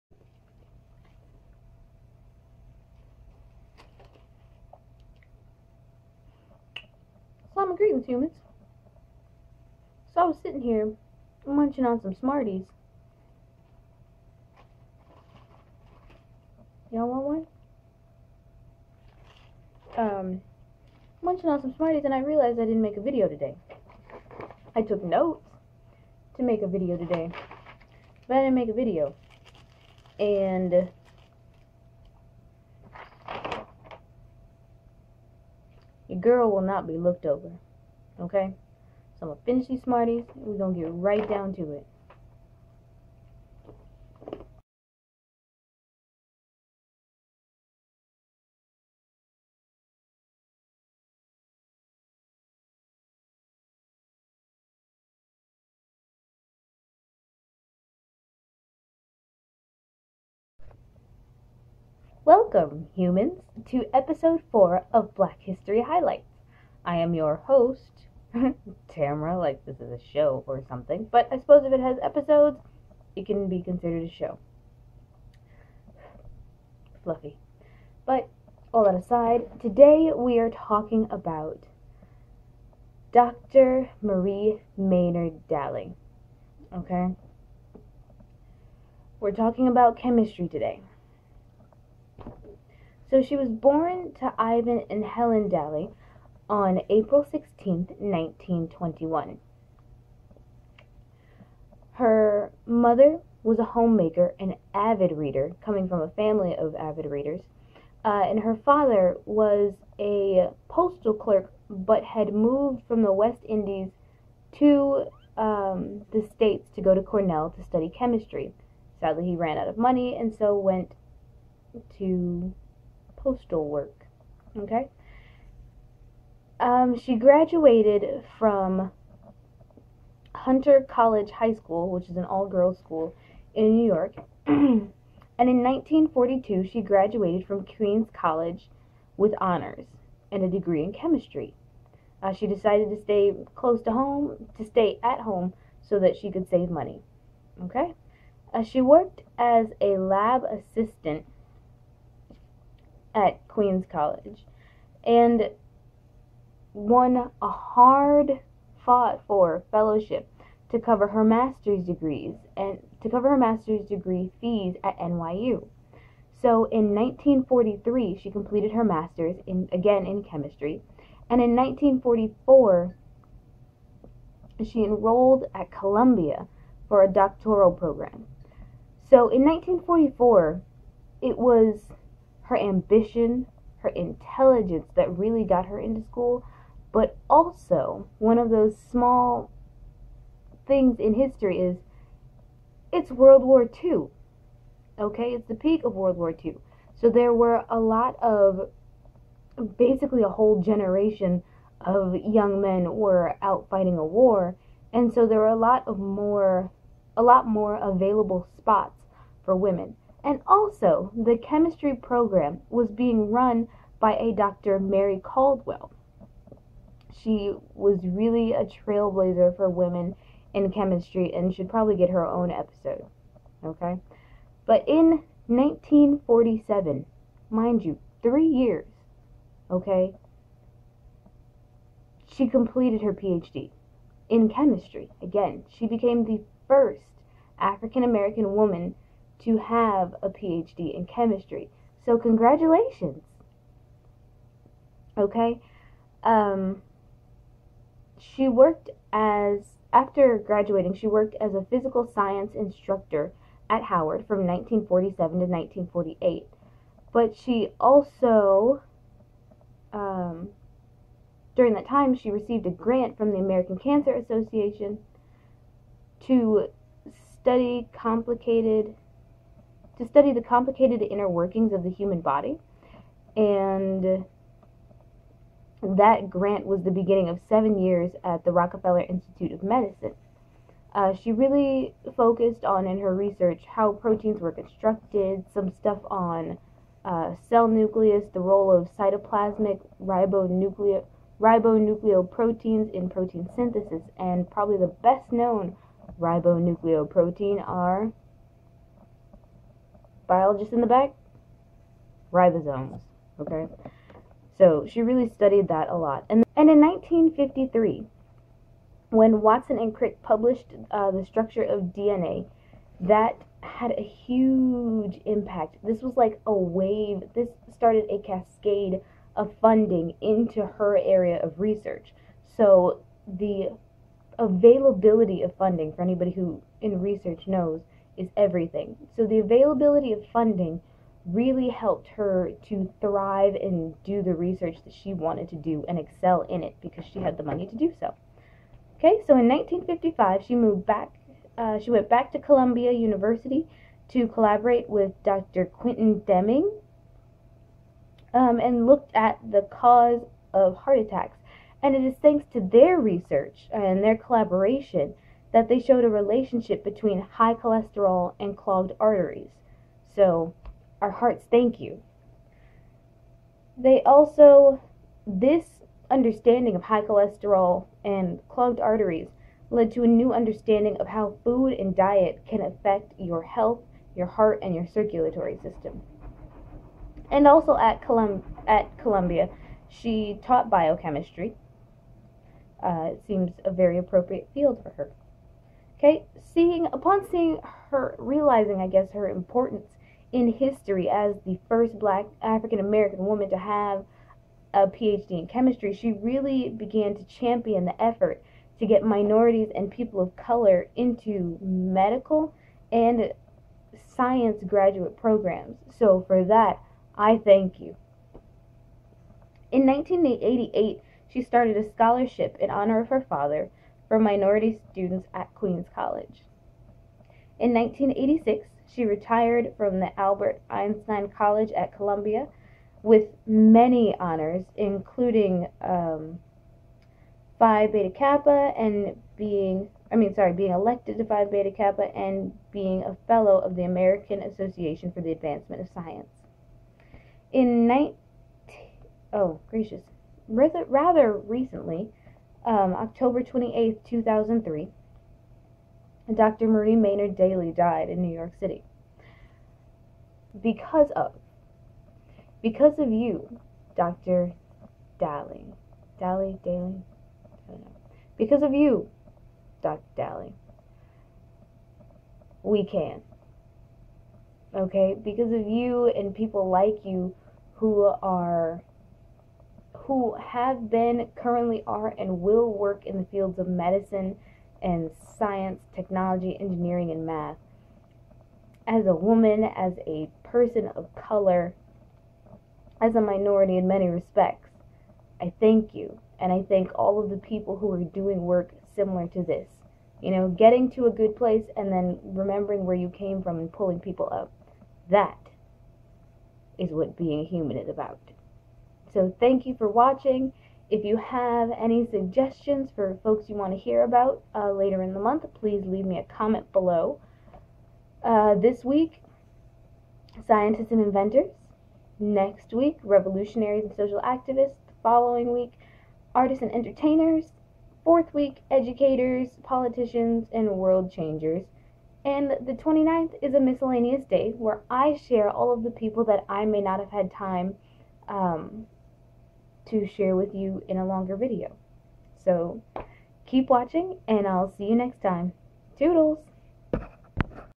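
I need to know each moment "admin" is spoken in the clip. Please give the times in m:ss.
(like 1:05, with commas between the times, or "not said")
not said.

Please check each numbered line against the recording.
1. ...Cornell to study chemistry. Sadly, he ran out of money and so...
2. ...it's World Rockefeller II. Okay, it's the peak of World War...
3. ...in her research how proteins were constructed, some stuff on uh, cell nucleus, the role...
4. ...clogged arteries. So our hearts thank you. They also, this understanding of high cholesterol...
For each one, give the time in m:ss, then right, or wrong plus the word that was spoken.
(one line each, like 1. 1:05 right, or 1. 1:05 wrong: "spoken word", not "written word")
1. 1:57 right
2. 3:12 wrong: "War", not "Rockefeller"
3. 4:42 right
4. 5:58 right.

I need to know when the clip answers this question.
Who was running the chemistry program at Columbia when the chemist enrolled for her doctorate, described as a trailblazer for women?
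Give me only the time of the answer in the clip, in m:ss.
3:34.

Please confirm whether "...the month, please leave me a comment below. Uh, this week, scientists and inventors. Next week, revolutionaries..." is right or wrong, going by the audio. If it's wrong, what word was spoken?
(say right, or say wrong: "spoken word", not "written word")
right.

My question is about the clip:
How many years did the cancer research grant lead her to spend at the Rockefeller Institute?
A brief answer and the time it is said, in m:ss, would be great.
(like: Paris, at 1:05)
7, at 4:37.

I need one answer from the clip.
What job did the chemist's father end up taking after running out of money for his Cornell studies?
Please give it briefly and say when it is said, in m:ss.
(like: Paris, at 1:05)
Postal clerk, at 1:50.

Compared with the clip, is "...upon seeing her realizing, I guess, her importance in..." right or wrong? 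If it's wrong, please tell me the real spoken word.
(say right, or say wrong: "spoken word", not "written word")
right.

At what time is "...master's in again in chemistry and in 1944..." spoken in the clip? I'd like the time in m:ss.
2:48.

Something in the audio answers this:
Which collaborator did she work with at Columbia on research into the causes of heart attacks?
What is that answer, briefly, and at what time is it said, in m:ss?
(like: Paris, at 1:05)
Dr. Quentin Deming, at 5:45.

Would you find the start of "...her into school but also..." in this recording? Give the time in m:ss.
3:05.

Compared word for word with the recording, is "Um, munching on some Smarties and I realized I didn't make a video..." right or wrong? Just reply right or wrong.
right.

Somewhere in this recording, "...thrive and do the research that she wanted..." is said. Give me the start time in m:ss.
5:32.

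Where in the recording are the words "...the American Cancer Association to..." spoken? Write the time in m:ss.
4:23.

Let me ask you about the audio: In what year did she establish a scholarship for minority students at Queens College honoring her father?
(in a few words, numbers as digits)
1988.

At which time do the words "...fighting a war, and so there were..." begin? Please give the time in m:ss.
3:23.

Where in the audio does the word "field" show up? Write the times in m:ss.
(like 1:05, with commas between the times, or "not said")
6:24, 7:53.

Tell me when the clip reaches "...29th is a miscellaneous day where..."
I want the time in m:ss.
8:42.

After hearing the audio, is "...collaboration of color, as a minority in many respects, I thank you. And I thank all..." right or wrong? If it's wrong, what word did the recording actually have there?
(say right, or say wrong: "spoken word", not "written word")
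wrong: "person", not "collaboration".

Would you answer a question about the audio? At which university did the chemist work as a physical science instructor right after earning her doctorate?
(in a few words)
Howard.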